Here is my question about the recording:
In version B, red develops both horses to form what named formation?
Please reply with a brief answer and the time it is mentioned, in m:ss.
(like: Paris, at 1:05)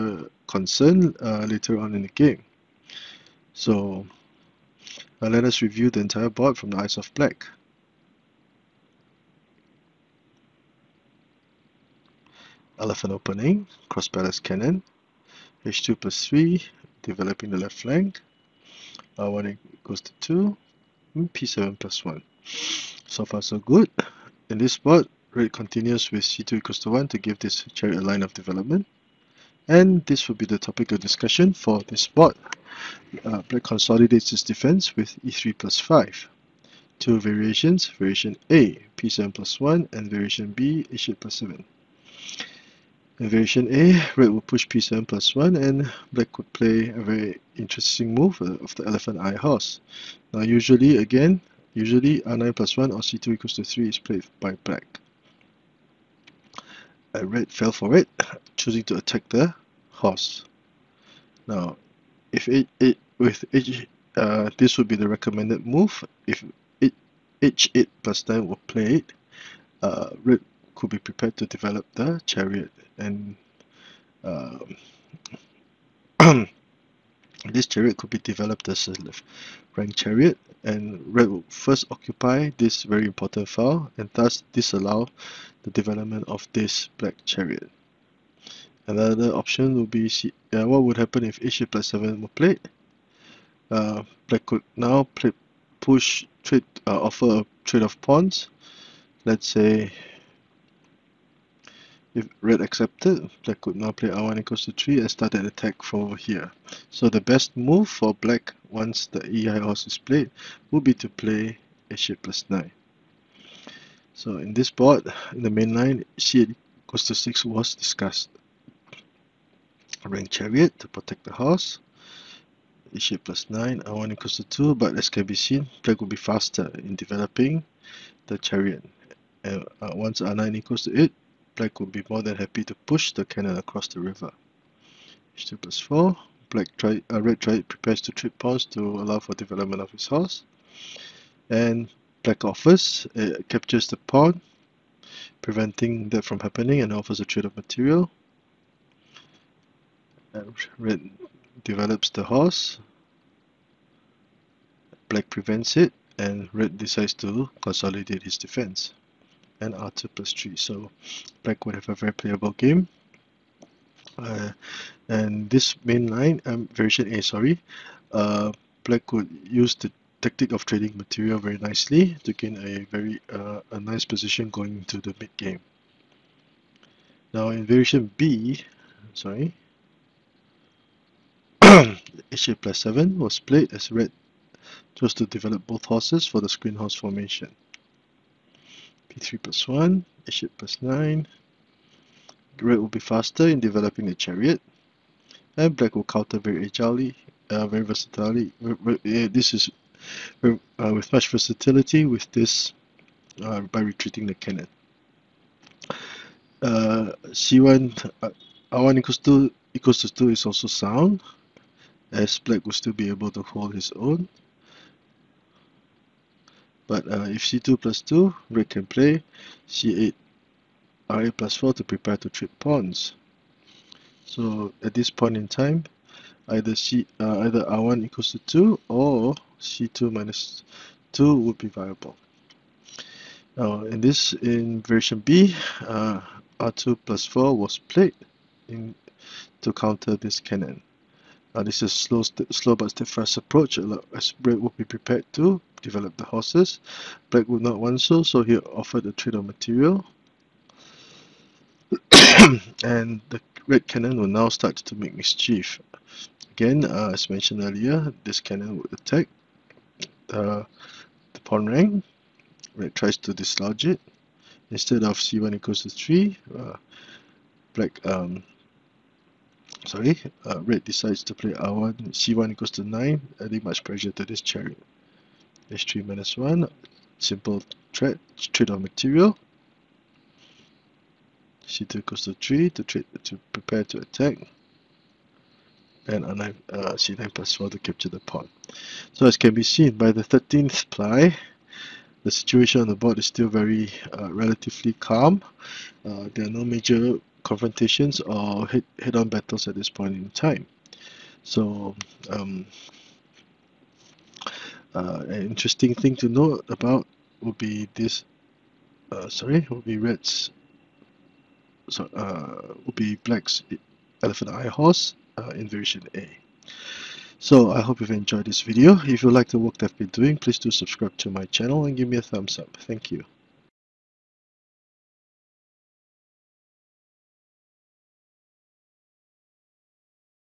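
screen horse formation, at 3:06.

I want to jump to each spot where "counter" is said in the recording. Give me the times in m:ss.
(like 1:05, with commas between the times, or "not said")
3:16, 3:59.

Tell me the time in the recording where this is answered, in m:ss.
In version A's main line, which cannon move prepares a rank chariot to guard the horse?
1:56.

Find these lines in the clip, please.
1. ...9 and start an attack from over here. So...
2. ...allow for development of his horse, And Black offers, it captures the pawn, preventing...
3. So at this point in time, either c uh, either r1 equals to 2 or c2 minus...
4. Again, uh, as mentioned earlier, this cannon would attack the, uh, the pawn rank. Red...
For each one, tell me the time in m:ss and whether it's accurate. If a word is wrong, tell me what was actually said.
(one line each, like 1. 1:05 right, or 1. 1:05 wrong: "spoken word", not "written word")
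1. 1:44 wrong: "3", not "9"
2. 2:18 right
3. 3:44 right
4. 4:16 right.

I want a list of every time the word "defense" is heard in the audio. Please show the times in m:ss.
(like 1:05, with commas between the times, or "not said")
0:34, 2:38.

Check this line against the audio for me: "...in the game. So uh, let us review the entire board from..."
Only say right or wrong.
right.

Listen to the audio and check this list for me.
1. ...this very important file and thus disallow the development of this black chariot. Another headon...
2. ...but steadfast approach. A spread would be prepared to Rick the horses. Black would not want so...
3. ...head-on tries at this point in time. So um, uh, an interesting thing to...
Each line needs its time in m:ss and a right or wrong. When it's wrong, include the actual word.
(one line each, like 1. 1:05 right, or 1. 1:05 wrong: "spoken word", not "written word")
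1. 1:22 wrong: "option", not "headon"
2. 4:02 wrong: "Develop", not "Rick"
3. 4:58 wrong: "battles", not "tries".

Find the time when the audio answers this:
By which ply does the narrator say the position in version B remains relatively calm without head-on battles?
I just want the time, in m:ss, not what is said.
4:50.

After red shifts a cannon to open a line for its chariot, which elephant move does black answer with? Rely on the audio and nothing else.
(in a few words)
e3 plus 5.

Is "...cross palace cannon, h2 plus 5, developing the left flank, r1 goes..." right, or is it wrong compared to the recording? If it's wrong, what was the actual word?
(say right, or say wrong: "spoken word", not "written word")
wrong: "3", not "5".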